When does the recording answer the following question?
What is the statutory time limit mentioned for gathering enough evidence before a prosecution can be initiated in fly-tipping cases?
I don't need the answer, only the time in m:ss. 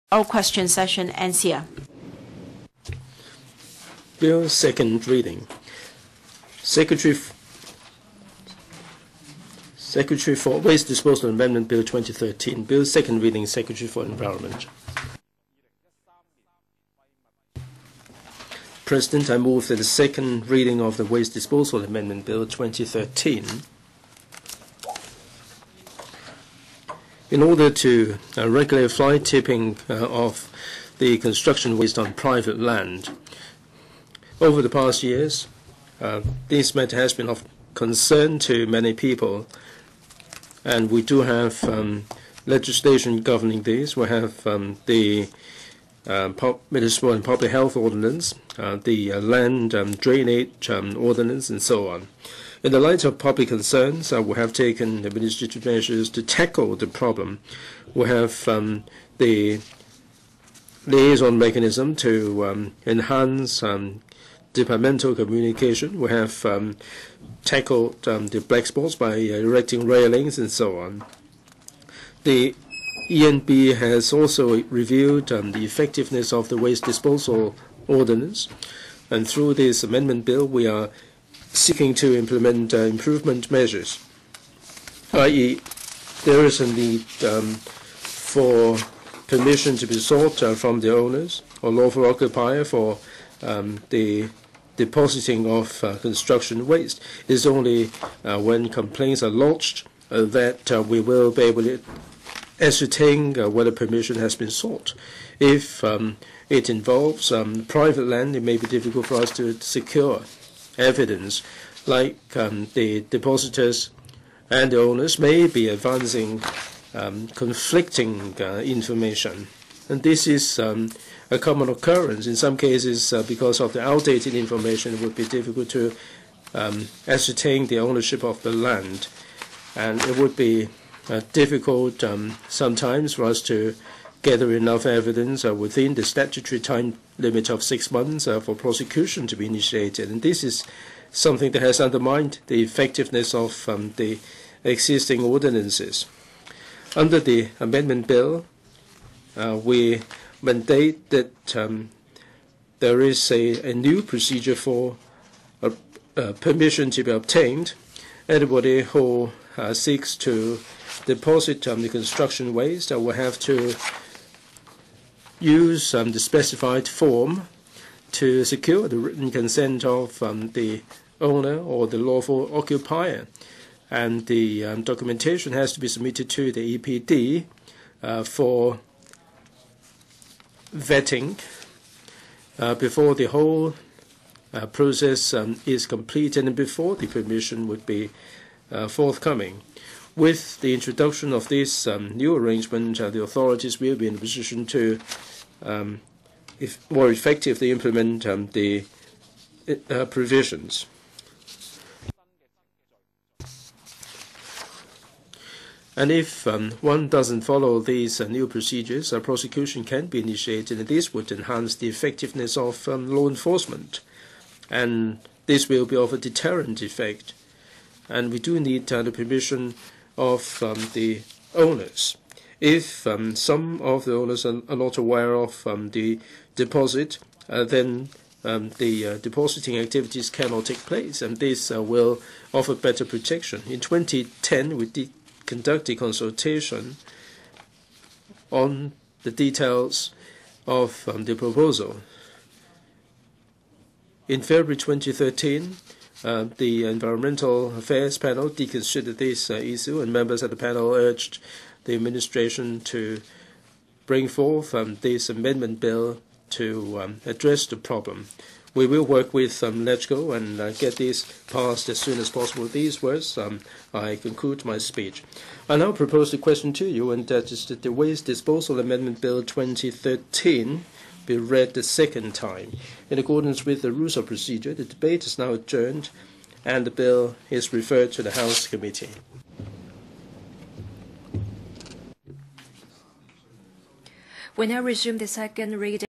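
2:17.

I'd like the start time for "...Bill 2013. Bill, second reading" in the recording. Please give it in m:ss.
0:11.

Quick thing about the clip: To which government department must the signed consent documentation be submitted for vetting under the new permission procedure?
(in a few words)
EPD.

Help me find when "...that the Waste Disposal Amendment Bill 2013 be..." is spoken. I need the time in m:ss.
4:27.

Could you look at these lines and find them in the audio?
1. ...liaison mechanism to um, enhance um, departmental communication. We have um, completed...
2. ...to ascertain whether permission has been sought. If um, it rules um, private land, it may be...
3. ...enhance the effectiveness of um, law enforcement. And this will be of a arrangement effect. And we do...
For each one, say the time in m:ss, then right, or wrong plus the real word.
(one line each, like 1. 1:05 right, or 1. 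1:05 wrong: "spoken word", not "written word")
1. 1:00 wrong: "tackled", not "completed"
2. 1:41 wrong: "involves", not "rules"
3. 3:31 wrong: "deterrent", not "arrangement".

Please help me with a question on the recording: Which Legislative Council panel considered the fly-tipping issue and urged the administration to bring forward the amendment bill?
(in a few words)
Environmental Affairs Panel.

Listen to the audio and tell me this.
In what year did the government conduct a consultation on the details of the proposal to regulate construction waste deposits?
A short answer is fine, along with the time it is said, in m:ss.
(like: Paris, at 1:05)
2010, at 3:53.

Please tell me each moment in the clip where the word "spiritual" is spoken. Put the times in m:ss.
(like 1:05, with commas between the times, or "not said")
not said.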